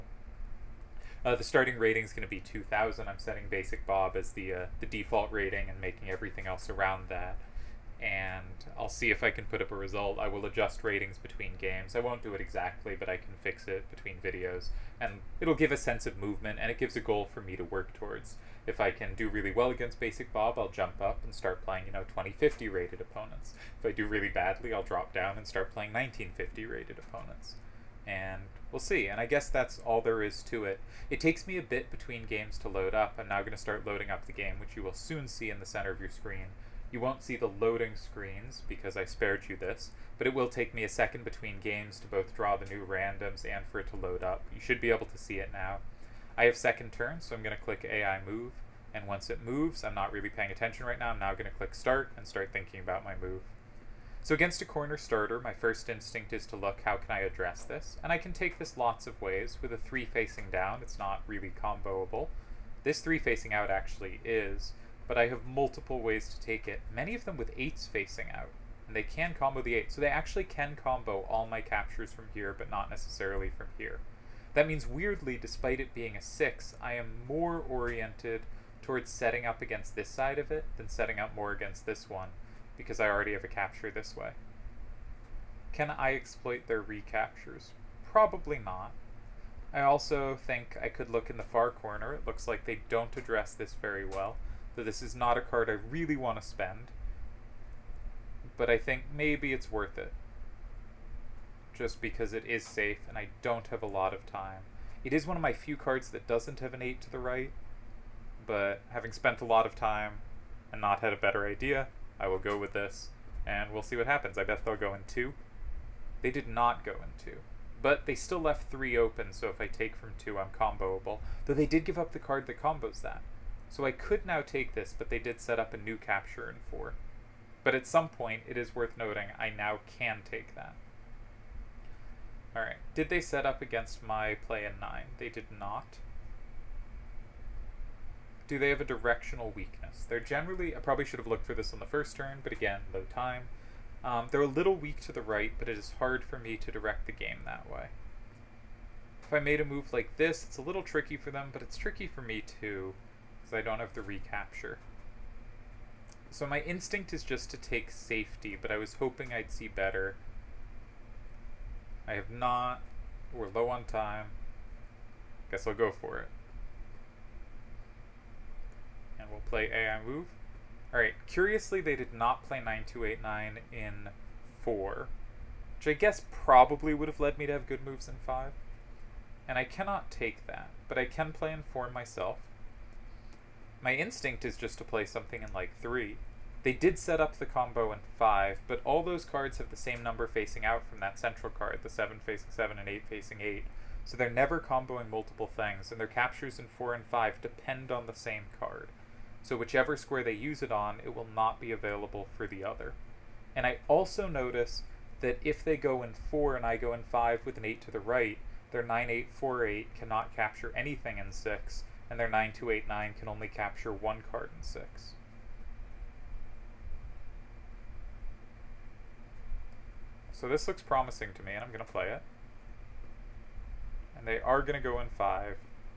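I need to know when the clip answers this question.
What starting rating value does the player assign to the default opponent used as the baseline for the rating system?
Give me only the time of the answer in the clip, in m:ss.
0:02.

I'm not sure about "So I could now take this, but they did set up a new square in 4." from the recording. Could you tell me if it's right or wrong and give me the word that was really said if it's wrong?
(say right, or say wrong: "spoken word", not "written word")
wrong: "capture", not "square".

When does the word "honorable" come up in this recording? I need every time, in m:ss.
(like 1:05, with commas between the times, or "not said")
not said.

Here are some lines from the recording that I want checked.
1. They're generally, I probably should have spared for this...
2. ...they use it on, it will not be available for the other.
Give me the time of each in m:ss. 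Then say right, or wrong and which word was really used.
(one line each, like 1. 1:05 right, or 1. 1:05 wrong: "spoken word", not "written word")
1. 2:20 wrong: "looked", not "spared"
2. 3:20 right.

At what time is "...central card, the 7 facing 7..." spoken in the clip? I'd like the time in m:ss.
3:11.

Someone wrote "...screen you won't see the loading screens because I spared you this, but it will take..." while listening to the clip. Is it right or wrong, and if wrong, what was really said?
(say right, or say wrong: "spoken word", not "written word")
right.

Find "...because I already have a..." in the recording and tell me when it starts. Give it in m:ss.
1:22.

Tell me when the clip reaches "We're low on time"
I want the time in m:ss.
2:43.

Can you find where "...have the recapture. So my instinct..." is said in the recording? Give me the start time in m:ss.
2:33.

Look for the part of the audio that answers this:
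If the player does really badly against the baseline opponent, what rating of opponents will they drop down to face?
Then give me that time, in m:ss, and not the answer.
0:25.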